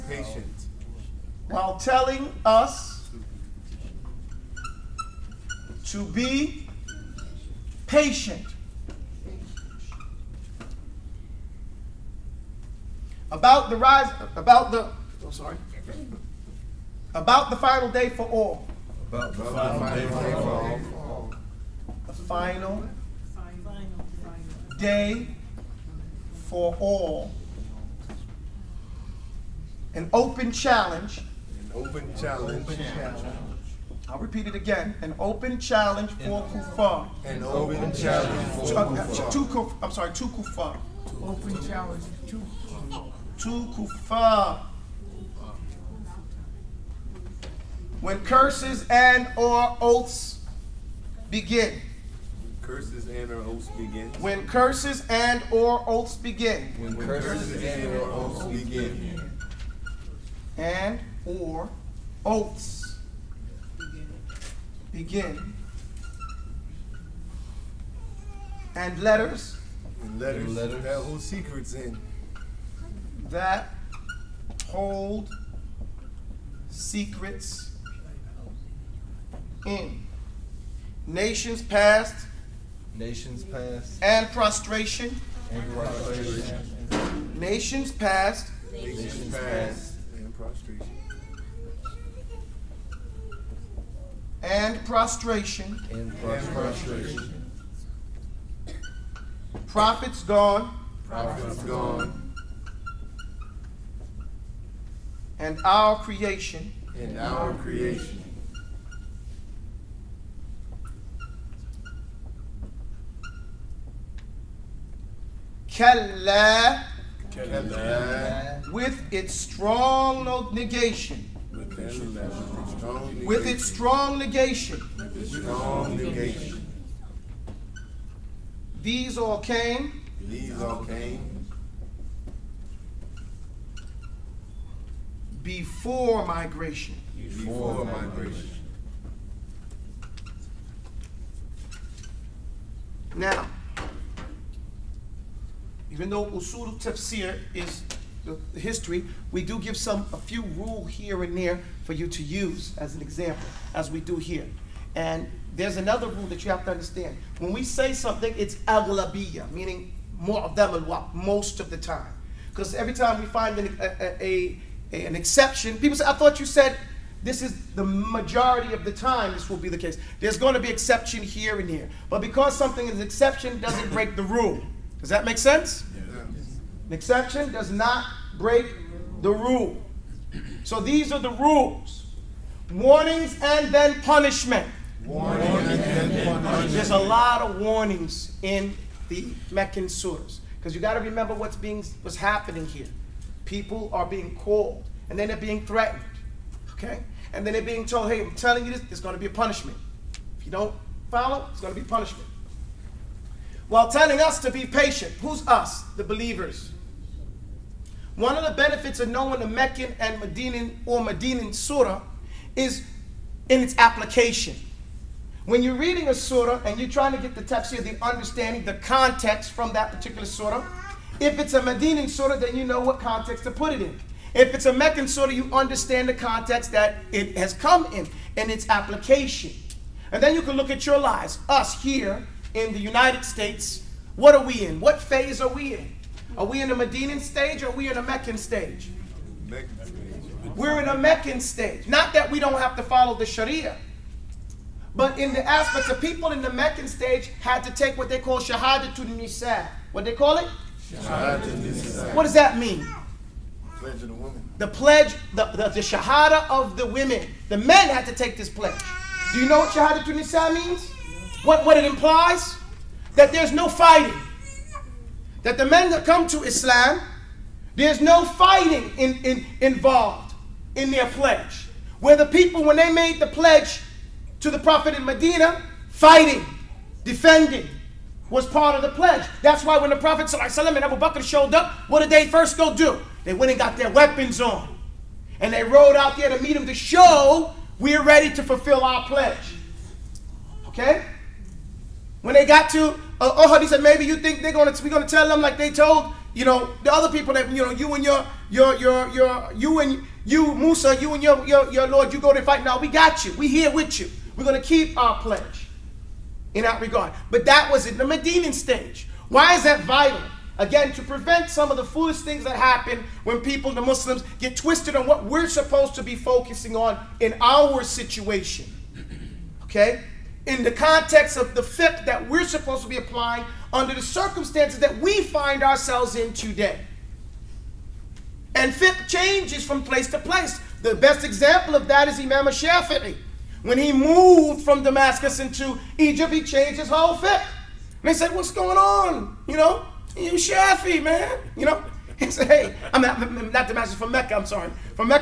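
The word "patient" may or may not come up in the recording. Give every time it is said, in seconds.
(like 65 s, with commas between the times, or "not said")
0 s, 7 s, 204 s.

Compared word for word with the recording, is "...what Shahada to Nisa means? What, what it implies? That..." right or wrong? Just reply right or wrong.
right.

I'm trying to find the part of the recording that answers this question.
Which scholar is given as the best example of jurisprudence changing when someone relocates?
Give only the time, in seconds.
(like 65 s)
332 s.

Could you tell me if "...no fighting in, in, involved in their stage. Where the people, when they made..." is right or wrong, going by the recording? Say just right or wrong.
wrong.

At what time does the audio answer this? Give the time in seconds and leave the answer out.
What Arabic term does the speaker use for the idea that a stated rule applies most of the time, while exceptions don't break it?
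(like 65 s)
158 s.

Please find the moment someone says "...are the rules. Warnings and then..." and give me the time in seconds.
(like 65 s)
181 s.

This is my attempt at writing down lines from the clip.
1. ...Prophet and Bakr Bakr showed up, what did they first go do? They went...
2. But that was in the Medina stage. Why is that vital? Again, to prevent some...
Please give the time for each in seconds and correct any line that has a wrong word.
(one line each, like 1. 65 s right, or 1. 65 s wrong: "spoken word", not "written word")
1. 279 s wrong: "Abu", not "Bakr"
2. 307 s right.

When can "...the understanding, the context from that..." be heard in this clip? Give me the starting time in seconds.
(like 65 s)
217 s.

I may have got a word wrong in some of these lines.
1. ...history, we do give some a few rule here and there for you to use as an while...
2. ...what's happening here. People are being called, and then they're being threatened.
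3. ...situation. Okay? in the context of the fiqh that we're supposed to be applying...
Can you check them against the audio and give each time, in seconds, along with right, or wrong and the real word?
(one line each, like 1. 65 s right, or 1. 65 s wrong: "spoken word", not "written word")
1. 148 s wrong: "example", not "while"
2. 191 s right
3. 317 s right.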